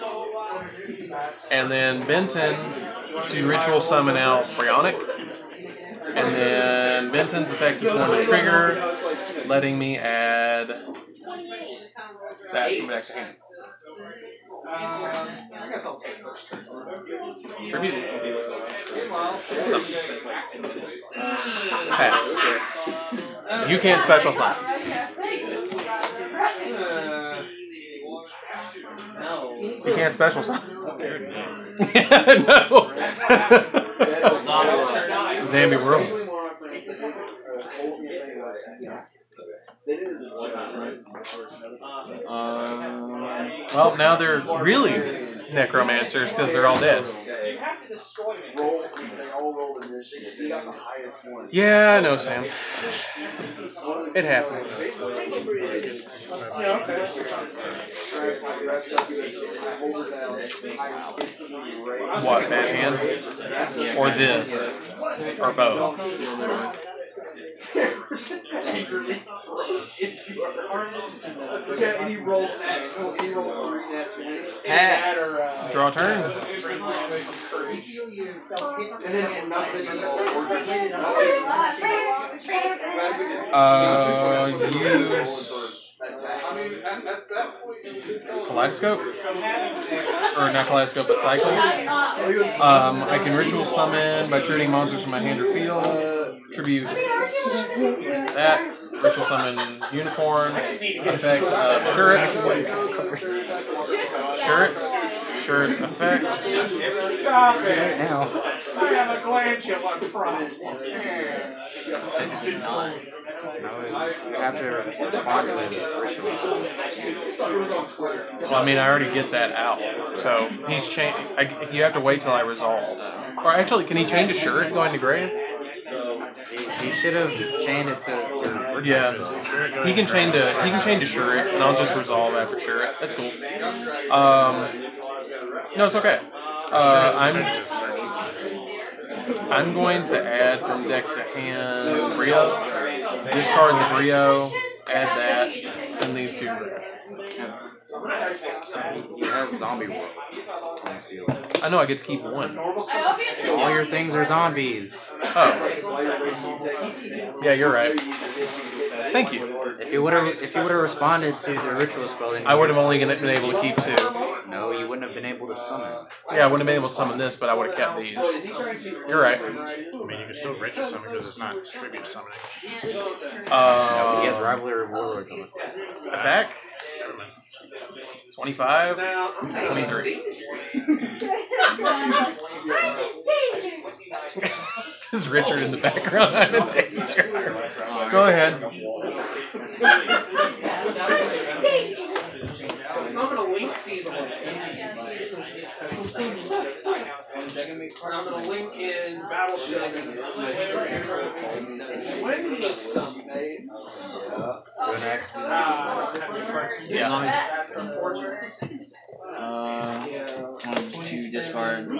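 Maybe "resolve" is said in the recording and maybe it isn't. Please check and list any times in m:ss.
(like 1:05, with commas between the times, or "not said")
2:02, 2:11.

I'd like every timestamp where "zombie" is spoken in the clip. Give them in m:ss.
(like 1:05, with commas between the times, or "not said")
0:35, 2:29, 2:34.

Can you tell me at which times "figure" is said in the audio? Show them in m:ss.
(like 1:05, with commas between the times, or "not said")
not said.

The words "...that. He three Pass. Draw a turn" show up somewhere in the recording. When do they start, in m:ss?
1:11.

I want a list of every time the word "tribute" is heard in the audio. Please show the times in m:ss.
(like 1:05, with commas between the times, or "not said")
0:17, 1:36, 2:51.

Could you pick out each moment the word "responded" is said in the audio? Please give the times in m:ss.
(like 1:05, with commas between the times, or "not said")
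2:40.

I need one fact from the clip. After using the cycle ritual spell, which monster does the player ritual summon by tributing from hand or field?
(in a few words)
Unicore.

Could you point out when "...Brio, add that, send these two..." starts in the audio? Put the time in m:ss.
2:23.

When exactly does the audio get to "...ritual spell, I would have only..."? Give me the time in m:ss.
2:41.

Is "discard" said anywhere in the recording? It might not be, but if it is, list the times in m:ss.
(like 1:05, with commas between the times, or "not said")
2:23, 3:31.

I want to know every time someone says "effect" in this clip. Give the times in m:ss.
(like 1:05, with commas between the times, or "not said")
0:07, 1:41, 1:45.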